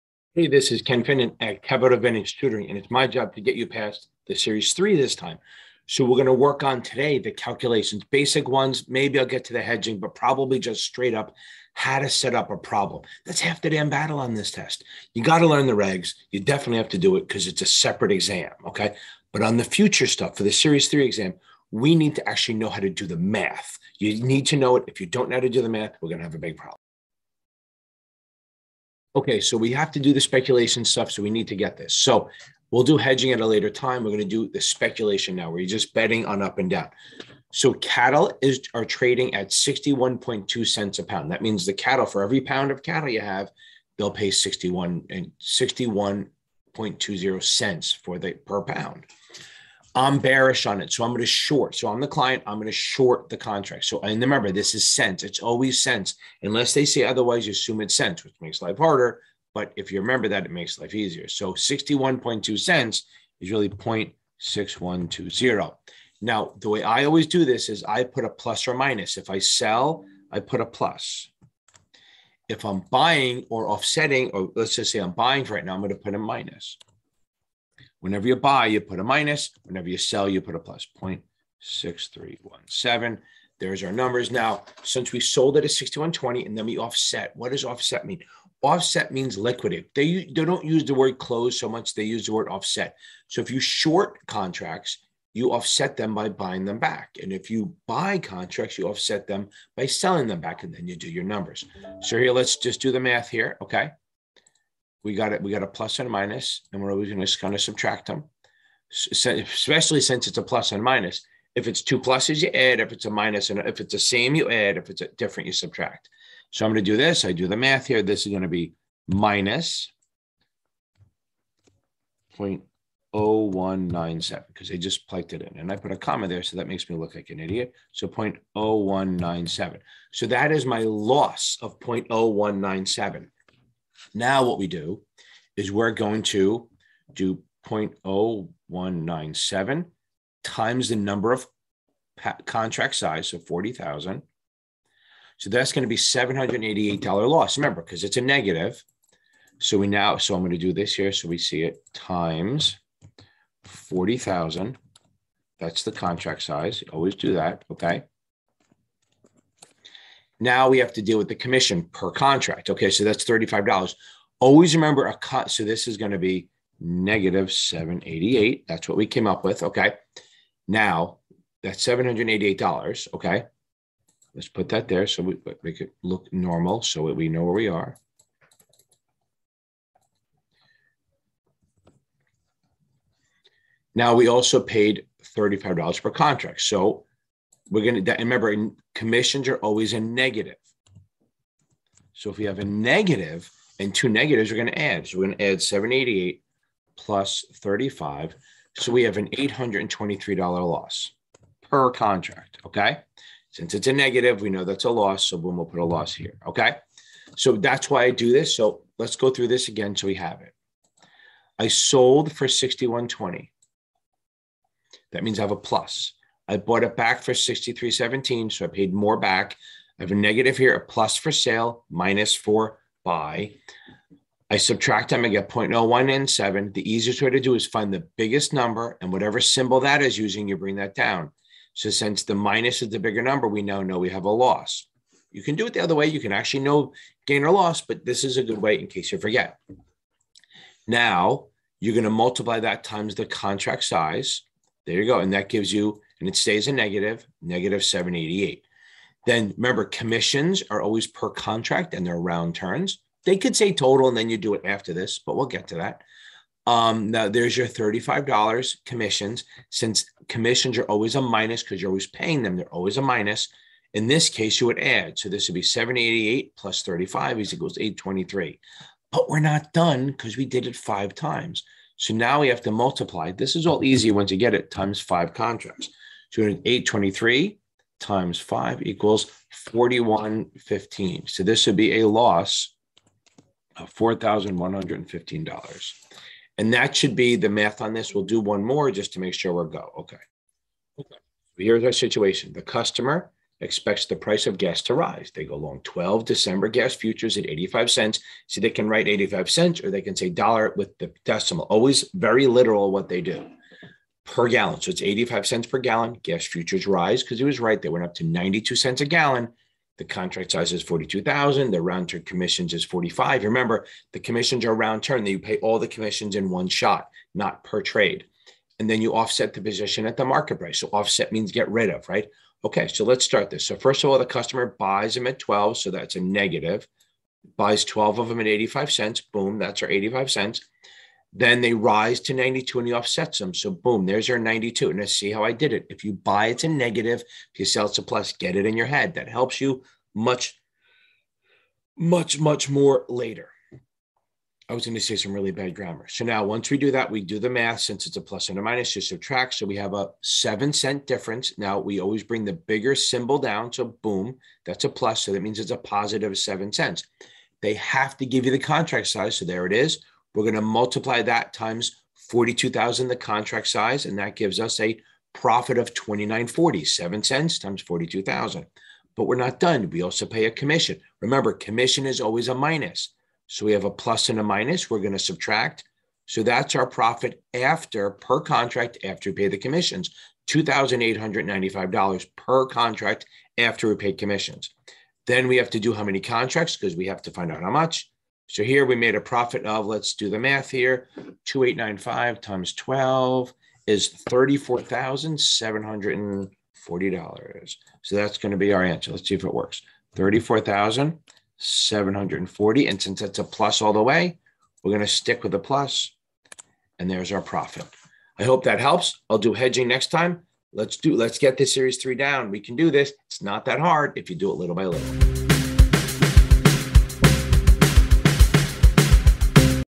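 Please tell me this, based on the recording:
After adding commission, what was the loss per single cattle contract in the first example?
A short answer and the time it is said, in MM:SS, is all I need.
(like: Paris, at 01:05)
$823, at 03:19.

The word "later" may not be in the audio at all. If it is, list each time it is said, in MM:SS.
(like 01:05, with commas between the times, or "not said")
00:33, 05:43.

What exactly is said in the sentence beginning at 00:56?
Unless they say otherwise, you assume it's cents, which makes life harder.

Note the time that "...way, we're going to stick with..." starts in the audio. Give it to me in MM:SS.
06:44.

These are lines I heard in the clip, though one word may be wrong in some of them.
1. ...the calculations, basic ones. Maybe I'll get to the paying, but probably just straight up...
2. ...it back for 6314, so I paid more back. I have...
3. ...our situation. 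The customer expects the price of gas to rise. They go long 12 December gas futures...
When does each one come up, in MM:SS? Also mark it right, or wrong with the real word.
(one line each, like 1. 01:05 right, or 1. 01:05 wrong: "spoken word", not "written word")
1. 00:07 wrong: "hedging", not "paying"
2. 03:36 wrong: "6317", not "6314"
3. 04:51 right.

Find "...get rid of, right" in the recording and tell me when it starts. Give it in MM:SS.
05:21.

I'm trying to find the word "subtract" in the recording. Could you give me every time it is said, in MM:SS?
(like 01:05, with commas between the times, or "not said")
01:47, 01:55, 03:44, 05:49, 06:15.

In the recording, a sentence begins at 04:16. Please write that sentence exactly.
Um, now there's your $35 commissions.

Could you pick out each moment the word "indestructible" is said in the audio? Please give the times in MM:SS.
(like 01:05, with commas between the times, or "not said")
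not said.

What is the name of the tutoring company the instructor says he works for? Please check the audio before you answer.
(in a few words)
Capital Advantage Tutoring.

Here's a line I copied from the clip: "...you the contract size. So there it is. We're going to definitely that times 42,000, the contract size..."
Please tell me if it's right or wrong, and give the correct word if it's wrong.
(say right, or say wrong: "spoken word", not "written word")
wrong: "multiply", not "definitely".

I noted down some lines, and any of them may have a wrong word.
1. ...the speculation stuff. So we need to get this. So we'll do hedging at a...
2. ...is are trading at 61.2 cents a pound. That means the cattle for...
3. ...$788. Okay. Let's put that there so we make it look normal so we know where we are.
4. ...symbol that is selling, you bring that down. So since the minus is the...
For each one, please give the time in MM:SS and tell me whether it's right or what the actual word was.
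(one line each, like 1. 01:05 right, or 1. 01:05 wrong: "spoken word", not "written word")
1. 00:30 right
2. 00:38 right
3. 02:51 right
4. 03:49 wrong: "using", not "selling".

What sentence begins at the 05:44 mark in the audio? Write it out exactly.
I was going to say some really bad grammar.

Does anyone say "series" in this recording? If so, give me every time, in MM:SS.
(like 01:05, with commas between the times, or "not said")
00:04, 00:20, 06:51.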